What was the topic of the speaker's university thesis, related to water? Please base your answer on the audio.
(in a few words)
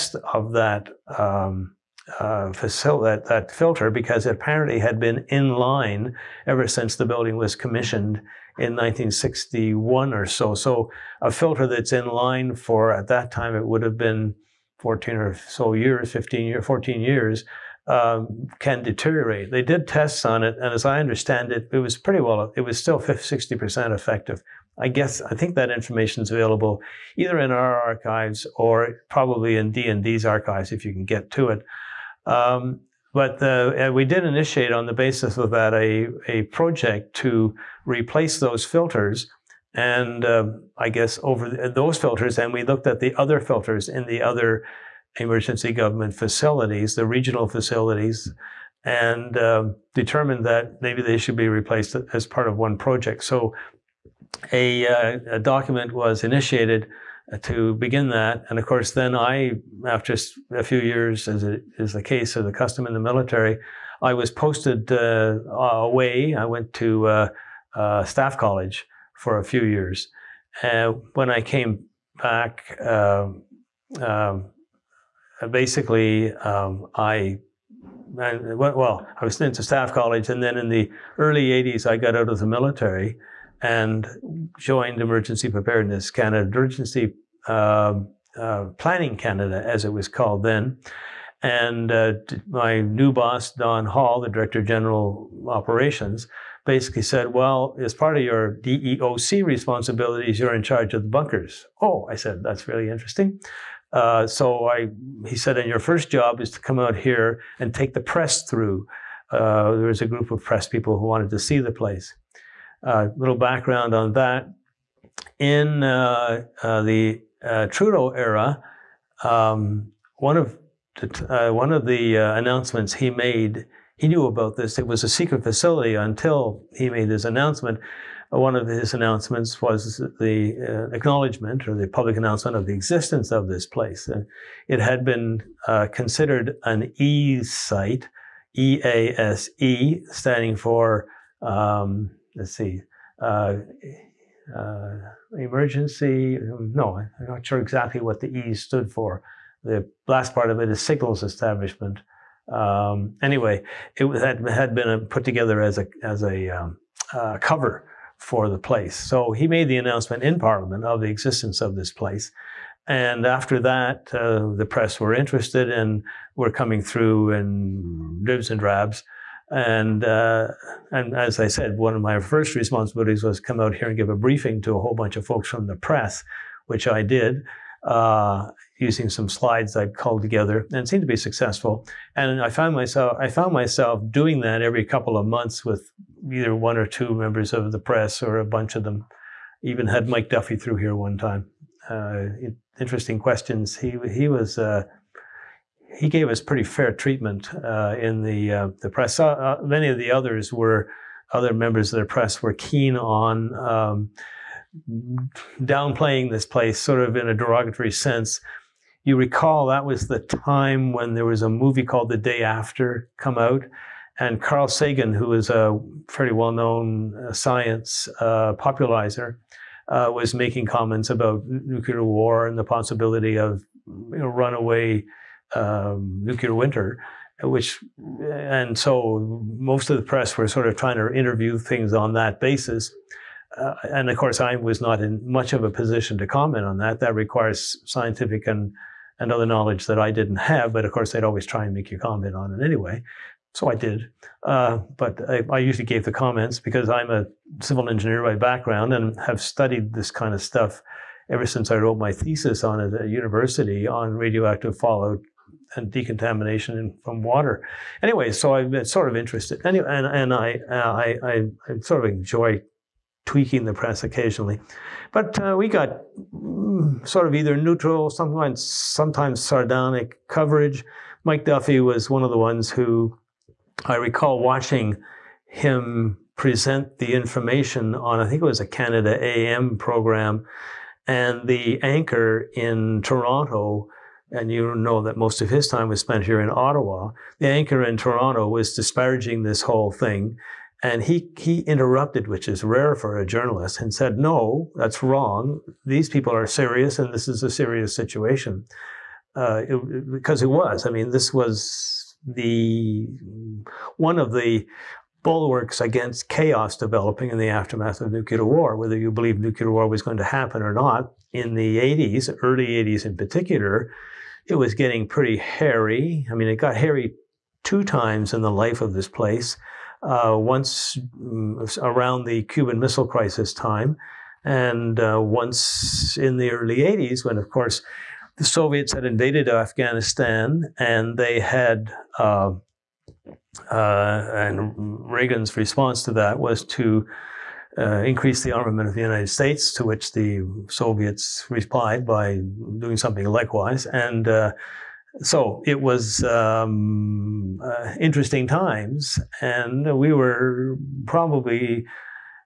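Radioactive fallout and decontamination.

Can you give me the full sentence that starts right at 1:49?
Uh, there was a group of press people who wanted to see the place.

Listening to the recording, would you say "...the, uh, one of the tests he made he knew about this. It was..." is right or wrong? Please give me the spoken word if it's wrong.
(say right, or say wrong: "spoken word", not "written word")
wrong: "announcements", not "tests".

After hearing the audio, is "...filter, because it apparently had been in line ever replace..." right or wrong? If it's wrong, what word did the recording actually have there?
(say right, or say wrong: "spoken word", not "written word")
wrong: "since", not "replace".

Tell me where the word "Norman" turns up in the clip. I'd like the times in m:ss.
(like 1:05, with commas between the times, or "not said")
not said.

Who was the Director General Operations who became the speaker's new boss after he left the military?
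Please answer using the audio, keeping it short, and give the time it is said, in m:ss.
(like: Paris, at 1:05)
Don Hall, at 1:33.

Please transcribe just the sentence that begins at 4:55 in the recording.
These people are serious, and this is a serious situation.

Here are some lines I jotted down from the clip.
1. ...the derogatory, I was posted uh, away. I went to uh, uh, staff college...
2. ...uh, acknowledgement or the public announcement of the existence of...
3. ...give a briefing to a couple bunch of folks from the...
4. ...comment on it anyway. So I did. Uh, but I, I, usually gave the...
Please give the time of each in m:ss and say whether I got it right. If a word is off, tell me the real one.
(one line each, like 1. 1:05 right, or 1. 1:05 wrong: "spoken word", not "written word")
1. 1:02 wrong: "military", not "derogatory"
2. 2:10 right
3. 2:53 wrong: "whole", not "couple"
4. 4:01 right.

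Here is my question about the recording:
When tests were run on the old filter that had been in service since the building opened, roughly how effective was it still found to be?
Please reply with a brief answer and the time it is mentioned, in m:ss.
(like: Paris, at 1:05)
50-60%, at 0:22.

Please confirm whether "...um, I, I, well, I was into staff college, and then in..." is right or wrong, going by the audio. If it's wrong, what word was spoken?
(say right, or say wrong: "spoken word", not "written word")
right.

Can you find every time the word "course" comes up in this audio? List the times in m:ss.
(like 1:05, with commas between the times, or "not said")
0:58, 3:54, 4:00, 5:27.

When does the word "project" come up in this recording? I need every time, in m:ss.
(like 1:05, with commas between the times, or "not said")
0:36, 0:52.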